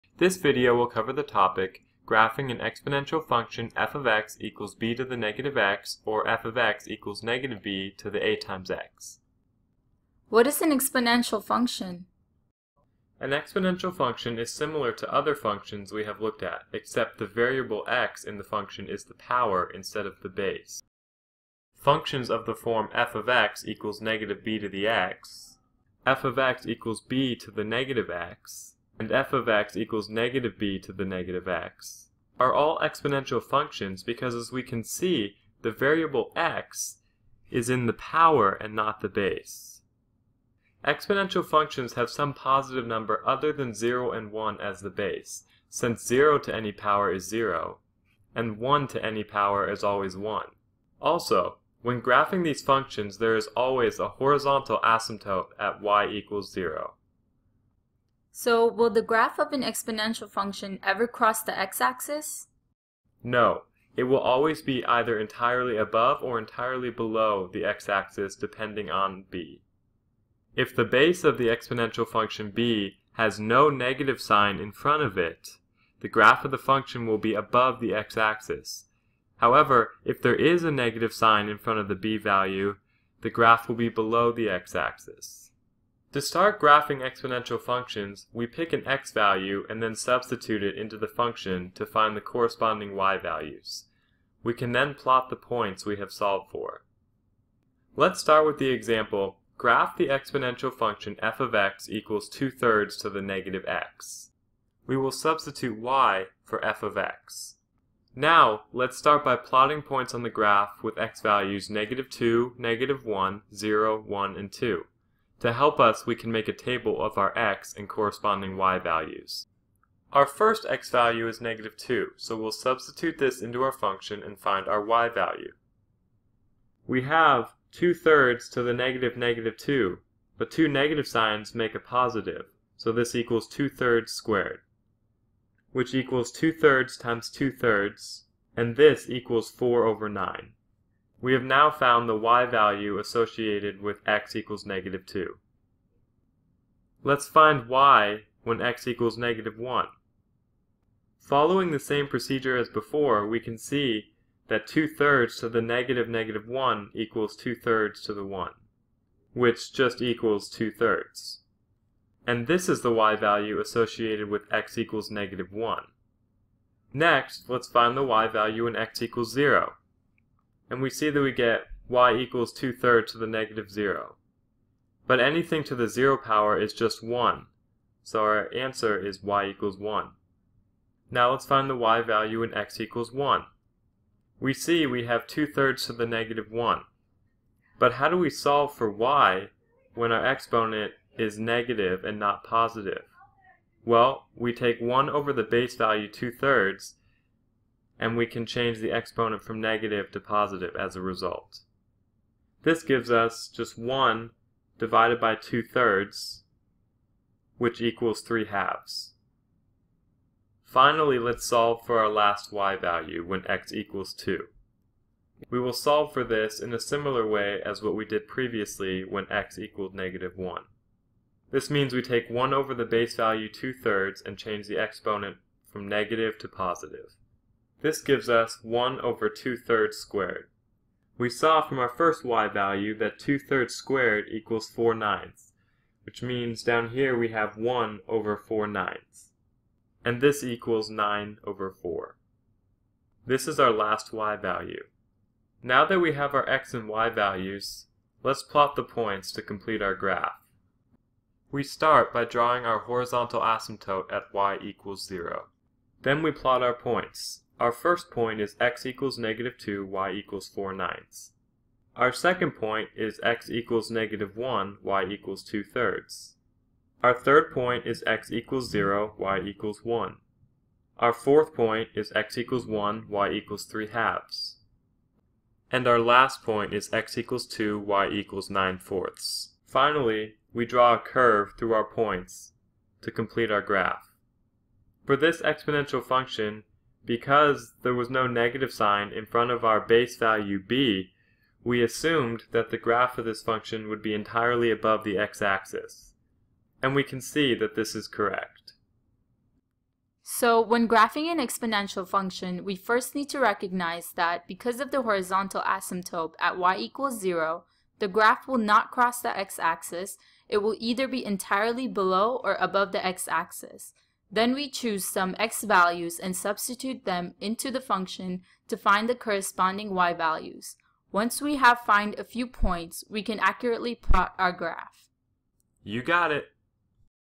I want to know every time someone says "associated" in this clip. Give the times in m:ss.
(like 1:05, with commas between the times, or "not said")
2:22, 2:43.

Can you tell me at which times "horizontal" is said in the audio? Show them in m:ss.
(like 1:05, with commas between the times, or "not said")
0:54, 4:12, 5:05.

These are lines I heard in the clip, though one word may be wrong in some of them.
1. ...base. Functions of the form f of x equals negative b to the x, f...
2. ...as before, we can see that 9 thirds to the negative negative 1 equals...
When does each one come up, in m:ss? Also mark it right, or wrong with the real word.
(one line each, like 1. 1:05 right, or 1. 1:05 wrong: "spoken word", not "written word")
1. 0:20 right
2. 2:32 wrong: "2", not "9".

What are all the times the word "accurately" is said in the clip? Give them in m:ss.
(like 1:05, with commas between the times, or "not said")
5:23.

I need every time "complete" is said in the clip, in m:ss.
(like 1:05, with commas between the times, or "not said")
4:09, 4:43.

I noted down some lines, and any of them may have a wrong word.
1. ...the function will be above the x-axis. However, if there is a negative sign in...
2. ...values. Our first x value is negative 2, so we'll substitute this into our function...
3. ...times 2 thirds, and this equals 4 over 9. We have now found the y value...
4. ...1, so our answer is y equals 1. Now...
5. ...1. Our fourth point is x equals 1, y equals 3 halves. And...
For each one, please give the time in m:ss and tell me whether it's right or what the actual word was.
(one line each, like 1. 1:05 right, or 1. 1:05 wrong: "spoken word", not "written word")
1. 1:16 right
2. 1:58 right
3. 2:16 right
4. 2:57 right
5. 4:29 right.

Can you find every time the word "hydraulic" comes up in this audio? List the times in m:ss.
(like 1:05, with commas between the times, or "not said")
not said.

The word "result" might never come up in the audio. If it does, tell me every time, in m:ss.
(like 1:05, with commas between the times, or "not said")
3:21.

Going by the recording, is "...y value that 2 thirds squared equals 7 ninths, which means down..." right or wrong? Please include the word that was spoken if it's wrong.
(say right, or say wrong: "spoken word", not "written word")
wrong: "4", not "7".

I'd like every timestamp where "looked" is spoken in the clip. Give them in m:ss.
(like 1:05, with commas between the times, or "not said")
0:16.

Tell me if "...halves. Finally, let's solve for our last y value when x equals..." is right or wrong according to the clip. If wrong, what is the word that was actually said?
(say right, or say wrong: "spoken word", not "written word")
right.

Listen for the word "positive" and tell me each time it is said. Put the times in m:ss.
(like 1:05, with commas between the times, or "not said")
0:42, 2:11, 3:12, 3:20, 3:46.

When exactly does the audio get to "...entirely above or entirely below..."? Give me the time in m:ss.
1:05.